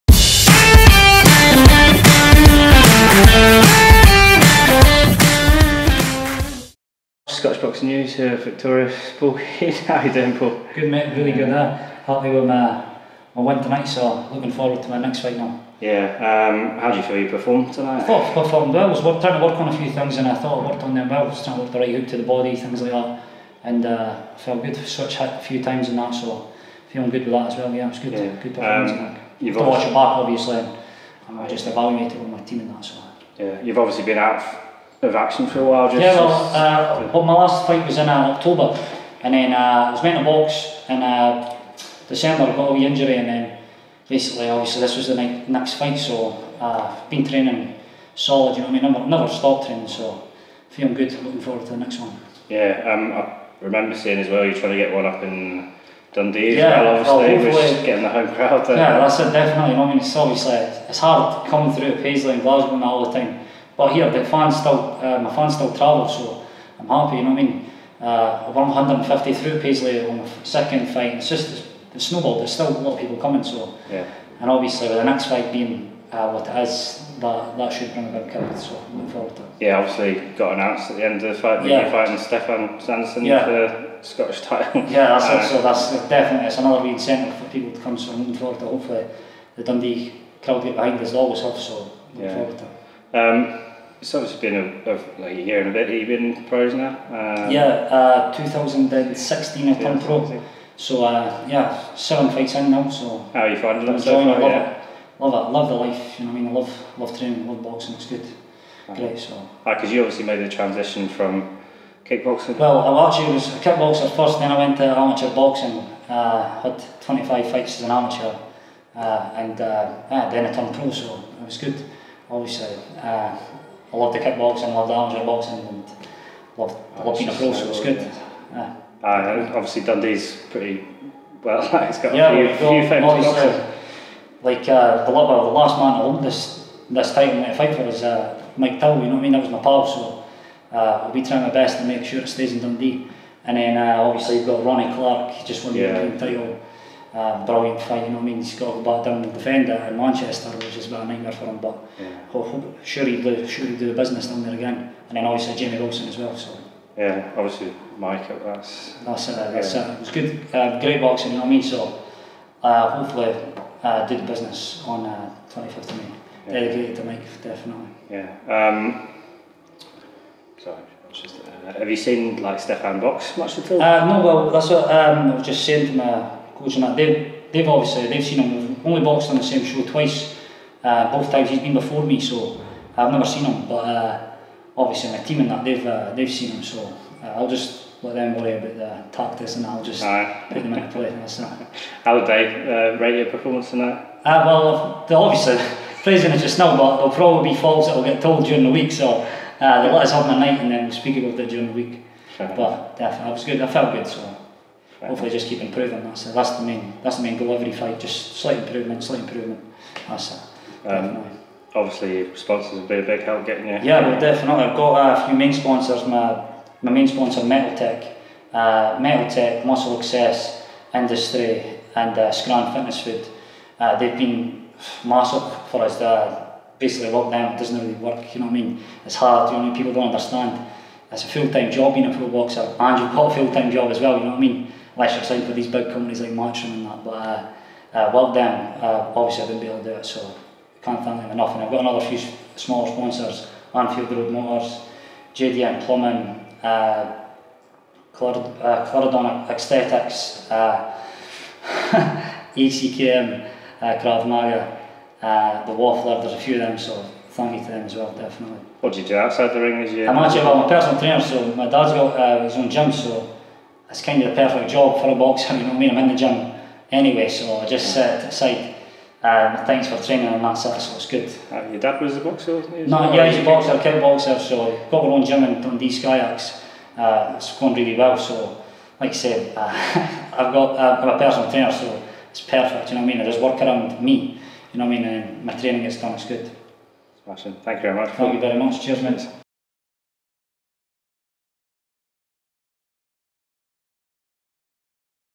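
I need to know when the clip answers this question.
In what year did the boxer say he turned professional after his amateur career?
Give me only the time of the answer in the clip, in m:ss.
1:38.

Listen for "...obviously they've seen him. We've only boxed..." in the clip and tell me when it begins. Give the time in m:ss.
2:57.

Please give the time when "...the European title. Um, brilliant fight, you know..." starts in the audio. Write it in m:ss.
2:25.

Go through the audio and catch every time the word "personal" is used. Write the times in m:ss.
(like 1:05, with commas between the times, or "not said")
4:20, 4:41.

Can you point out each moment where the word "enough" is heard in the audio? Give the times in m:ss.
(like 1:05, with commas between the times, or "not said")
3:22, 4:01.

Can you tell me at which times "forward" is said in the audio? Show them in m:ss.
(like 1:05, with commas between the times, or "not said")
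0:14, 0:51, 1:19, 1:28.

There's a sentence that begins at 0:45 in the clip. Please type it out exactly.
So uh, I've been training solid.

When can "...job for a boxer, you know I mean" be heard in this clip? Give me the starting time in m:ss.
4:24.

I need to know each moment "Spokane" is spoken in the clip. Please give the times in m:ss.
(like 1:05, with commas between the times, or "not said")
0:08.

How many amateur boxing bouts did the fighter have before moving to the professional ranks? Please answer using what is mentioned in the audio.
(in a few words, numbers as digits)
25.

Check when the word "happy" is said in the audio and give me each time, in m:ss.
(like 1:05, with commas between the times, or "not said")
0:11, 1:06.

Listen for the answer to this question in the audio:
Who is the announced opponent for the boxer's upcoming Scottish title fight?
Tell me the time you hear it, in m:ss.
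1:22.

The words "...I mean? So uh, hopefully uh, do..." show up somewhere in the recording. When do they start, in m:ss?
2:41.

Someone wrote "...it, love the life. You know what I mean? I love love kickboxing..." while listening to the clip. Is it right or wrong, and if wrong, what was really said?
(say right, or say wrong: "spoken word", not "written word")
wrong: "training", not "kickboxing".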